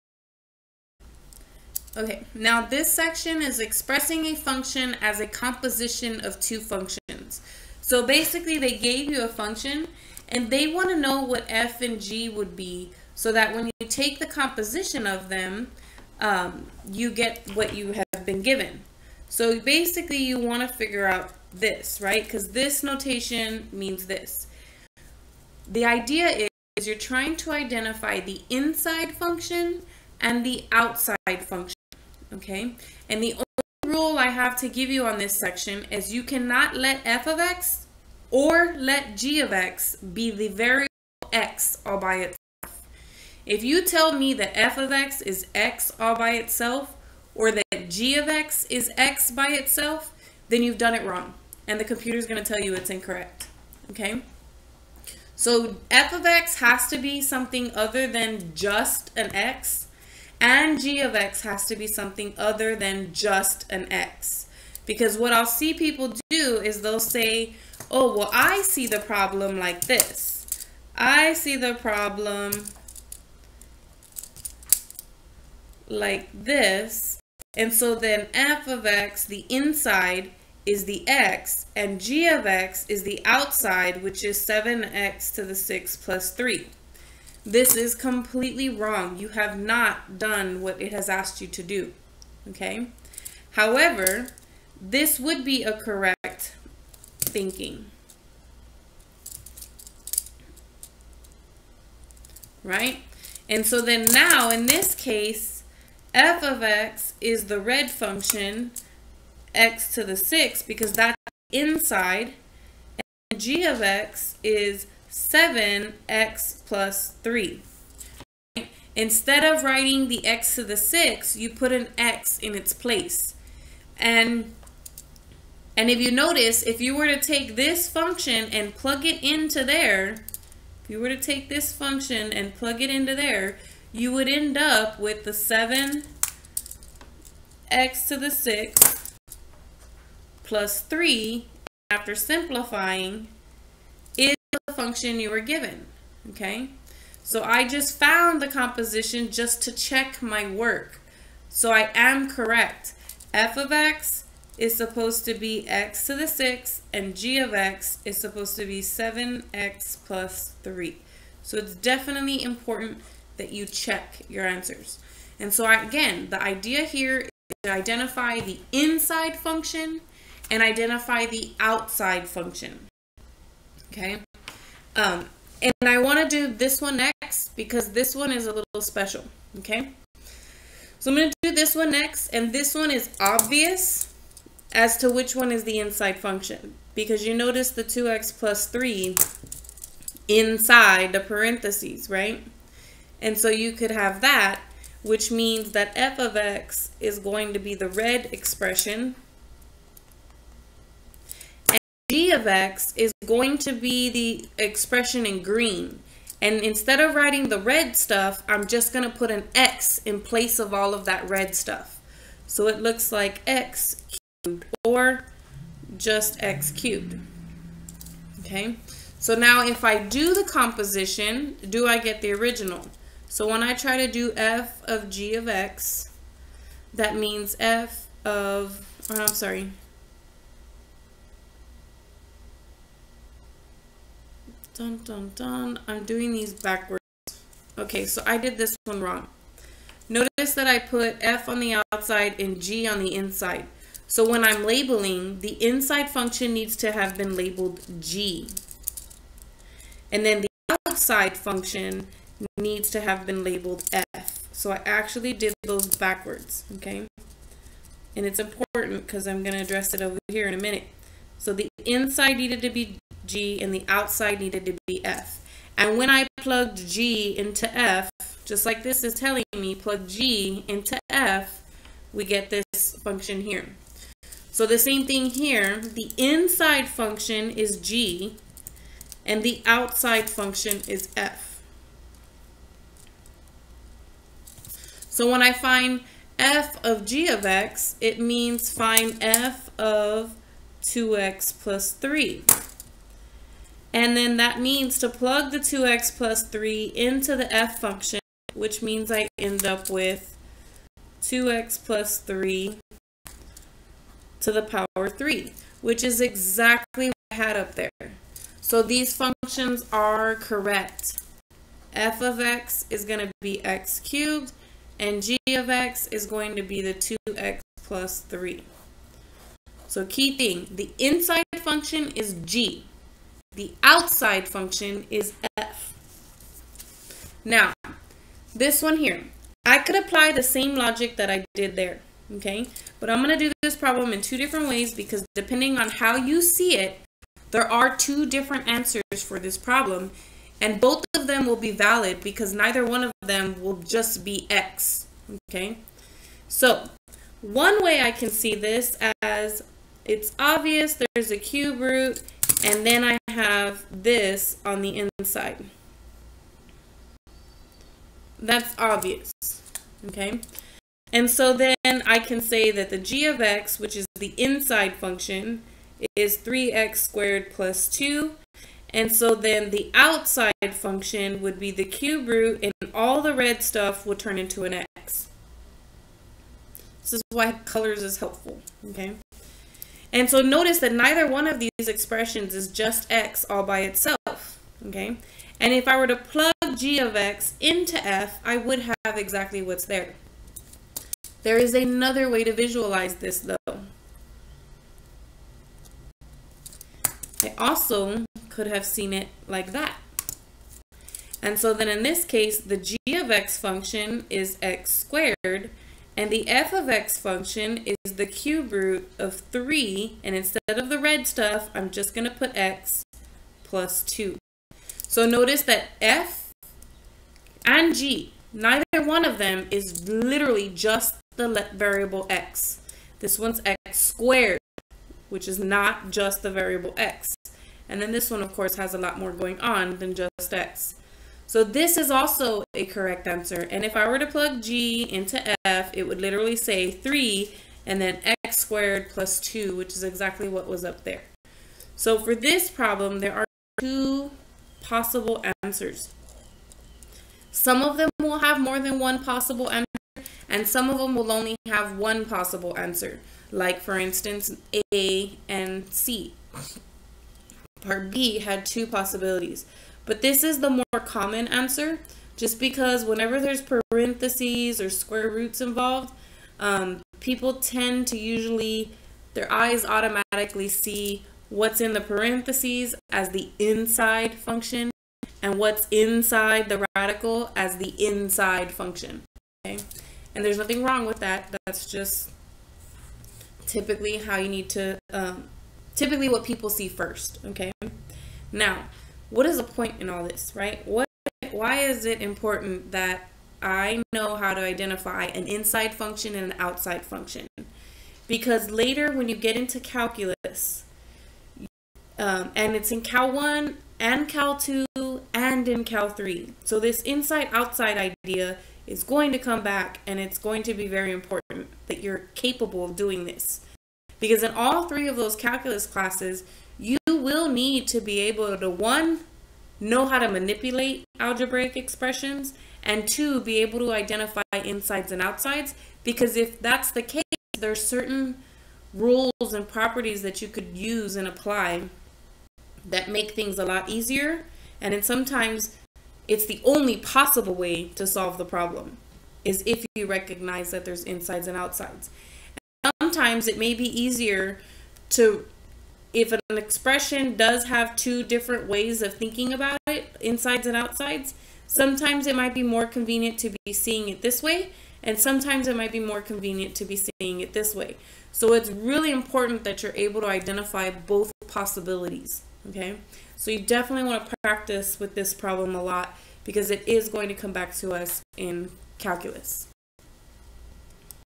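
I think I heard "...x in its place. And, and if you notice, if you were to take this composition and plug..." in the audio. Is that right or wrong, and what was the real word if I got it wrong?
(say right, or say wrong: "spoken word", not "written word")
wrong: "function", not "composition".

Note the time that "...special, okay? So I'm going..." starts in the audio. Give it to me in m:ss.
2:58.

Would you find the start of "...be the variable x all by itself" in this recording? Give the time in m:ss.
0:39.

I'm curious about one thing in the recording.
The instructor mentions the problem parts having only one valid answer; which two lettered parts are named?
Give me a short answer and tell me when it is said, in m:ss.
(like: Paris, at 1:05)
A and C, at 7:34.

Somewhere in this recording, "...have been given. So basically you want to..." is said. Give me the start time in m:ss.
0:17.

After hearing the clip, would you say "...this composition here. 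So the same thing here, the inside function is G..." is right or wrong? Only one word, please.
wrong.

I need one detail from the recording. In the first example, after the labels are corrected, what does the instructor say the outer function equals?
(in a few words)
7x plus 3.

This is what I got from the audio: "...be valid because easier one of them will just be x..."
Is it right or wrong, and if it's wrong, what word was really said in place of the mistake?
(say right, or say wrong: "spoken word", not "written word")
wrong: "neither", not "easier".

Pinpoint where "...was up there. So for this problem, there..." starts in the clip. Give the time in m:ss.
7:20.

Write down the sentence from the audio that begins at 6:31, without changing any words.
There is another way to visualize this though.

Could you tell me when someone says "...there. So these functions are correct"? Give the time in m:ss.
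5:07.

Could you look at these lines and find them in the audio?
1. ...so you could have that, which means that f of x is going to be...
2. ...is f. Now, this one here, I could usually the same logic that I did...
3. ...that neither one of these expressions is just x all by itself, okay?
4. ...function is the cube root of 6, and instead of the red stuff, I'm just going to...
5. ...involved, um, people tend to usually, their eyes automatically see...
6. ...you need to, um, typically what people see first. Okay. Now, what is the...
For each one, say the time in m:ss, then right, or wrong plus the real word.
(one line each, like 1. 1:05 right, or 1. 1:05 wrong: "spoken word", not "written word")
1. 3:13 right
2. 5:25 wrong: "apply", not "usually"
3. 6:20 right
4. 6:47 wrong: "3", not "6"
5. 7:45 right
6. 8:04 right.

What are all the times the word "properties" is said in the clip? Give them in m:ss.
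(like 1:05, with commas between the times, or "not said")
8:49.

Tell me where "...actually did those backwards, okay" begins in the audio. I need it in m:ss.
4:14.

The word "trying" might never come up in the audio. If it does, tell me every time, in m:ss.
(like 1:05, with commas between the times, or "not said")
0:26.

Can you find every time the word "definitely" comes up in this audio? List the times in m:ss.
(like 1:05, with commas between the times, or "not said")
2:41, 9:23.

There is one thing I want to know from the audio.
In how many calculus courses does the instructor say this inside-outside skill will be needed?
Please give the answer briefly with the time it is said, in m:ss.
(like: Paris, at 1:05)
3, at 8:34.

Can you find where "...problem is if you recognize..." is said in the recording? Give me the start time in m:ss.
8:58.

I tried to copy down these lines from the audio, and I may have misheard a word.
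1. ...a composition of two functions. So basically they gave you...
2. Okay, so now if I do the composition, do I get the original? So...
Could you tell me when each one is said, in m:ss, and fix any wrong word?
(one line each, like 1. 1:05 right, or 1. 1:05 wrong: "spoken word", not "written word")
1. 0:05 right
2. 3:38 right.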